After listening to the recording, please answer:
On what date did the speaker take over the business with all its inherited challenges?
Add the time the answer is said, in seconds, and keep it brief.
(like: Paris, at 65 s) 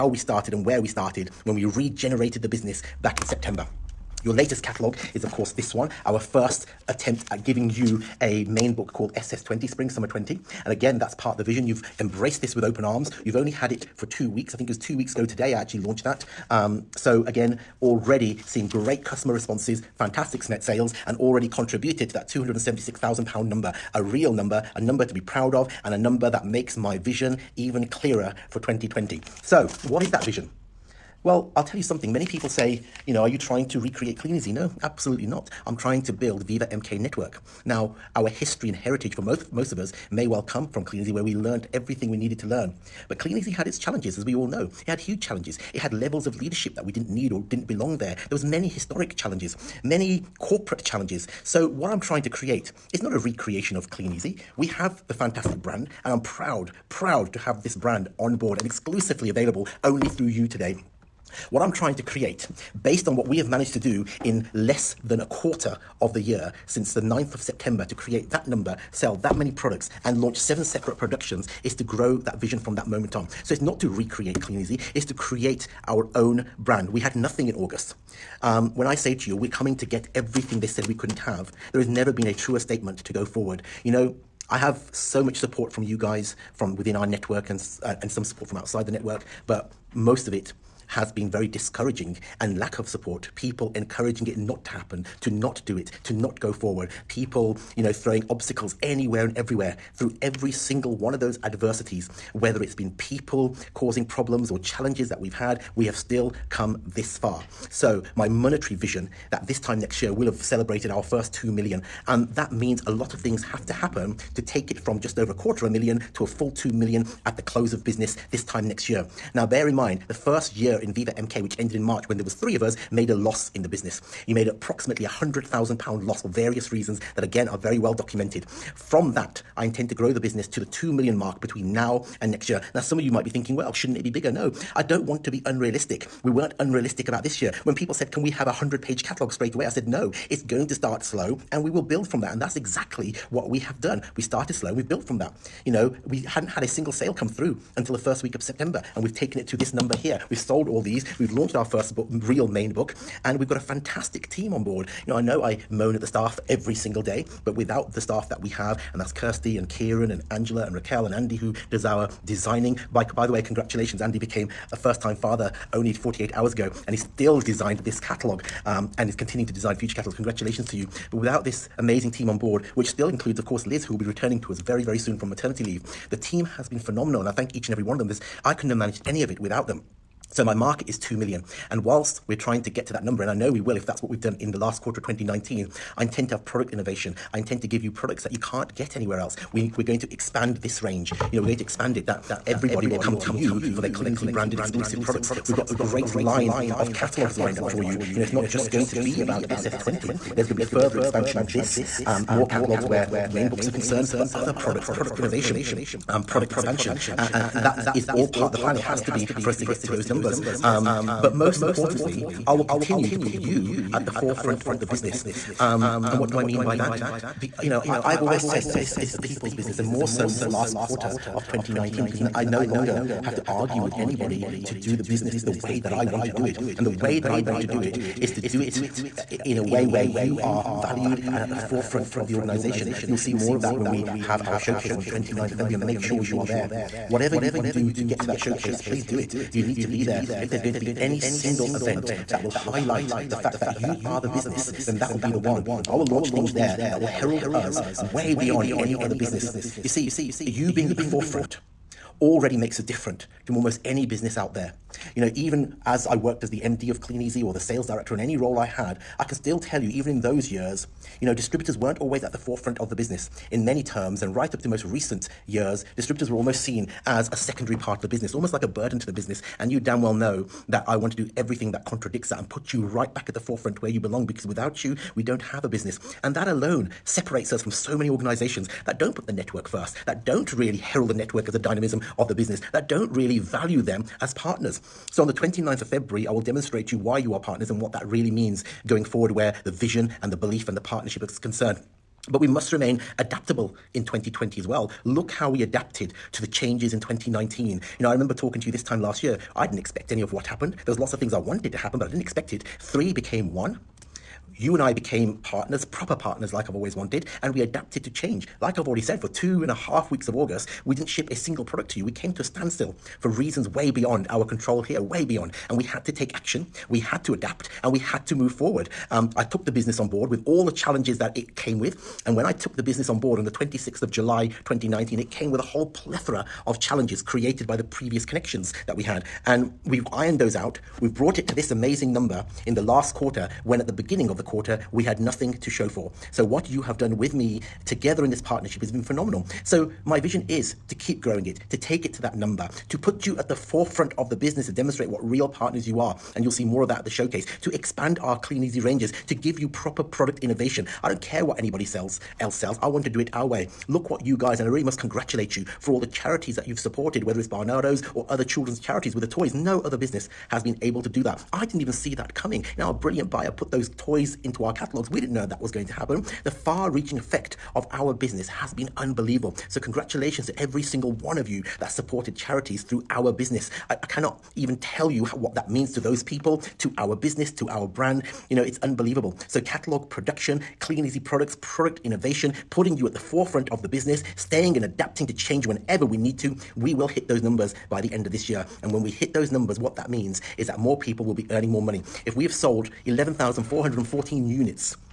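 26 July 2019, at 323 s.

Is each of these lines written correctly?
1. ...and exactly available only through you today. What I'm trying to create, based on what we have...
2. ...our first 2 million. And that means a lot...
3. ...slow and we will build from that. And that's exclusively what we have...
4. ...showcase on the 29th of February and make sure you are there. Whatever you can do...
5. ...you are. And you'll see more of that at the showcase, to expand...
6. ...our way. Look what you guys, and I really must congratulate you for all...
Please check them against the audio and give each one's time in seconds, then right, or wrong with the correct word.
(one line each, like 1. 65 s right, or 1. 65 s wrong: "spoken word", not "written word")
1. 58 s wrong: "exclusively", not "exactly"
2. 110 s right
3. 141 s wrong: "exactly", not "exclusively"
4. 234 s right
5. 345 s right
6. 353 s right.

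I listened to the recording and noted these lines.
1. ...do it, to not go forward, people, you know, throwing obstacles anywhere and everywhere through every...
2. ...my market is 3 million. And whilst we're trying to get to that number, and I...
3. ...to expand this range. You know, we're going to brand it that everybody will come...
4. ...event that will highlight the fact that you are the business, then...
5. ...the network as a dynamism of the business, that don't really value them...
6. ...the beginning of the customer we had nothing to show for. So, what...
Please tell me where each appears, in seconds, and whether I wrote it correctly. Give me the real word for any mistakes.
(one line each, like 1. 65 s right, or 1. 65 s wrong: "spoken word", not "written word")
1. 95 s right
2. 180 s wrong: "2", not "3"
3. 189 s wrong: "expand", not "brand"
4. 241 s right
5. 281 s right
6. 333 s wrong: "quarter", not "customer".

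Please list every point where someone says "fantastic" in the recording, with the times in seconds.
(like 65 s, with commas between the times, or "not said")
19 s, 55 s, 153 s.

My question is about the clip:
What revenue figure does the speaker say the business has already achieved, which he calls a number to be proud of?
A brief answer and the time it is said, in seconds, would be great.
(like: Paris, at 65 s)
£276,000, at 22 s.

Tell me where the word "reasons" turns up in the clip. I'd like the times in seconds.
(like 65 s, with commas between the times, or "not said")
126 s, 313 s.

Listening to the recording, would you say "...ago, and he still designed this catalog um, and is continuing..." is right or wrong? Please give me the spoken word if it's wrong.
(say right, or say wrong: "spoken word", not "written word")
right.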